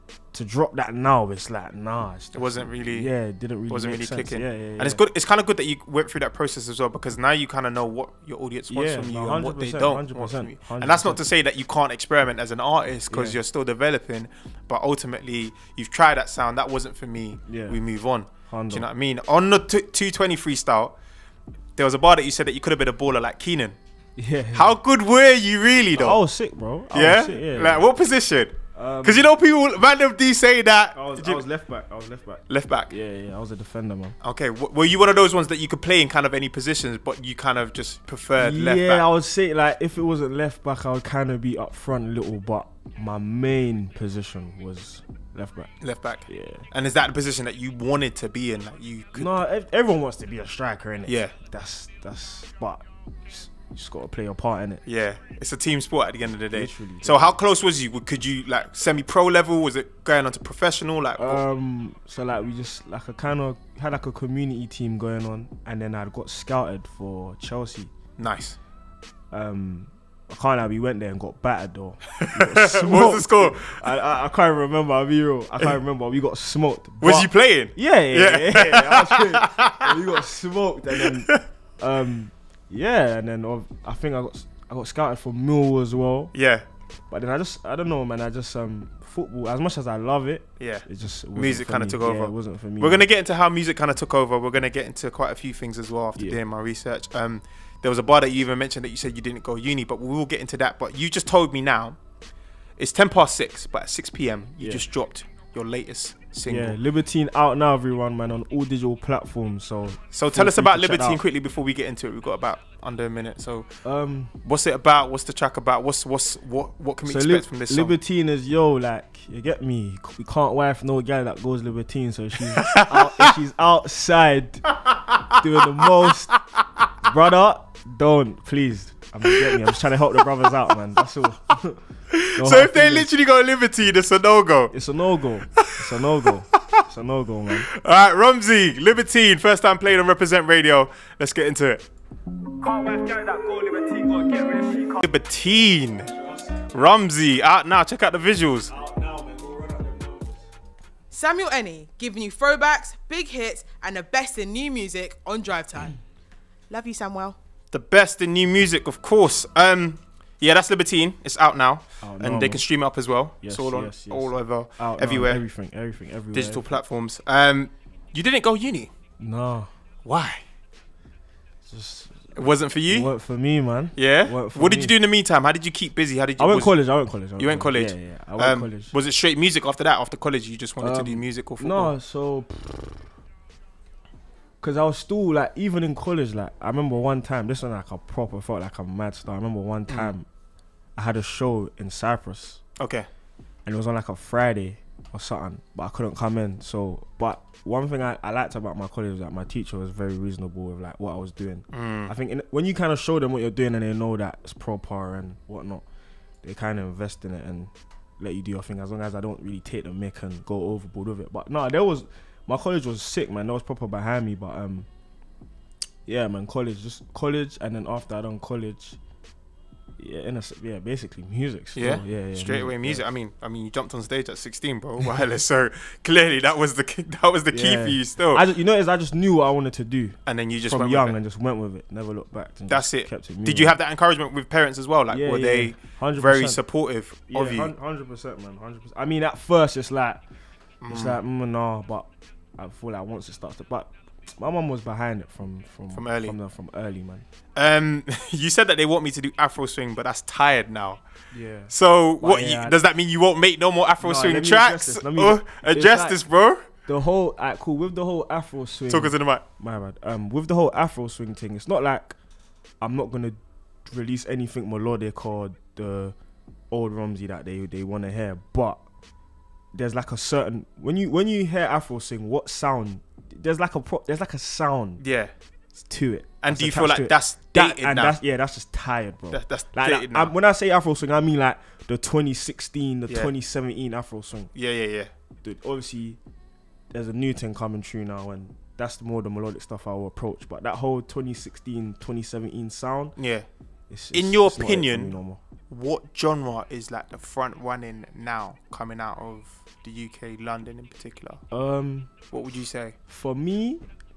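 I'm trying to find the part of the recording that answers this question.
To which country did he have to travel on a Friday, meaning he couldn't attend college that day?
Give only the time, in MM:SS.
03:11.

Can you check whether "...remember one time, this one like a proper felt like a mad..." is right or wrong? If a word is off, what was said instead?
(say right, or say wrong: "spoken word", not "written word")
right.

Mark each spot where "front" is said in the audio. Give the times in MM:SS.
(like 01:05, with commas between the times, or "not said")
00:41, 04:57.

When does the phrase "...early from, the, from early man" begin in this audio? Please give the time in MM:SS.
04:06.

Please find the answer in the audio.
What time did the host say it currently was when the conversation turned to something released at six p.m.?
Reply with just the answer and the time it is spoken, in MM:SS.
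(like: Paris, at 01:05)
Ten past six, at 01:42.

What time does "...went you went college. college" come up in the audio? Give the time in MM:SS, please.
02:57.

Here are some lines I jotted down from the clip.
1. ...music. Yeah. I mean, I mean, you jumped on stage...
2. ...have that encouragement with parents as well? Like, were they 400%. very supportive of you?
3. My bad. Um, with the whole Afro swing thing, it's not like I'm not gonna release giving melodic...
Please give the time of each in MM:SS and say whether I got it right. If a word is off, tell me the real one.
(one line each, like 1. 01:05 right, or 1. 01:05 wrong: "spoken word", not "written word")
1. 03:42 right
2. 03:53 wrong: "100", not "400"
3. 04:19 wrong: "anything", not "giving".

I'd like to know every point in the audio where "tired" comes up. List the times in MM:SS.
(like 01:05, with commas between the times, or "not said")
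04:10, 04:38.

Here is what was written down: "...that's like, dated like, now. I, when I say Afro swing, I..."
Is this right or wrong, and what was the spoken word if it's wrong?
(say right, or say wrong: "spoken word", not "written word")
right.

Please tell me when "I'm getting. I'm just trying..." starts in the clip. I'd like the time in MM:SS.
02:09.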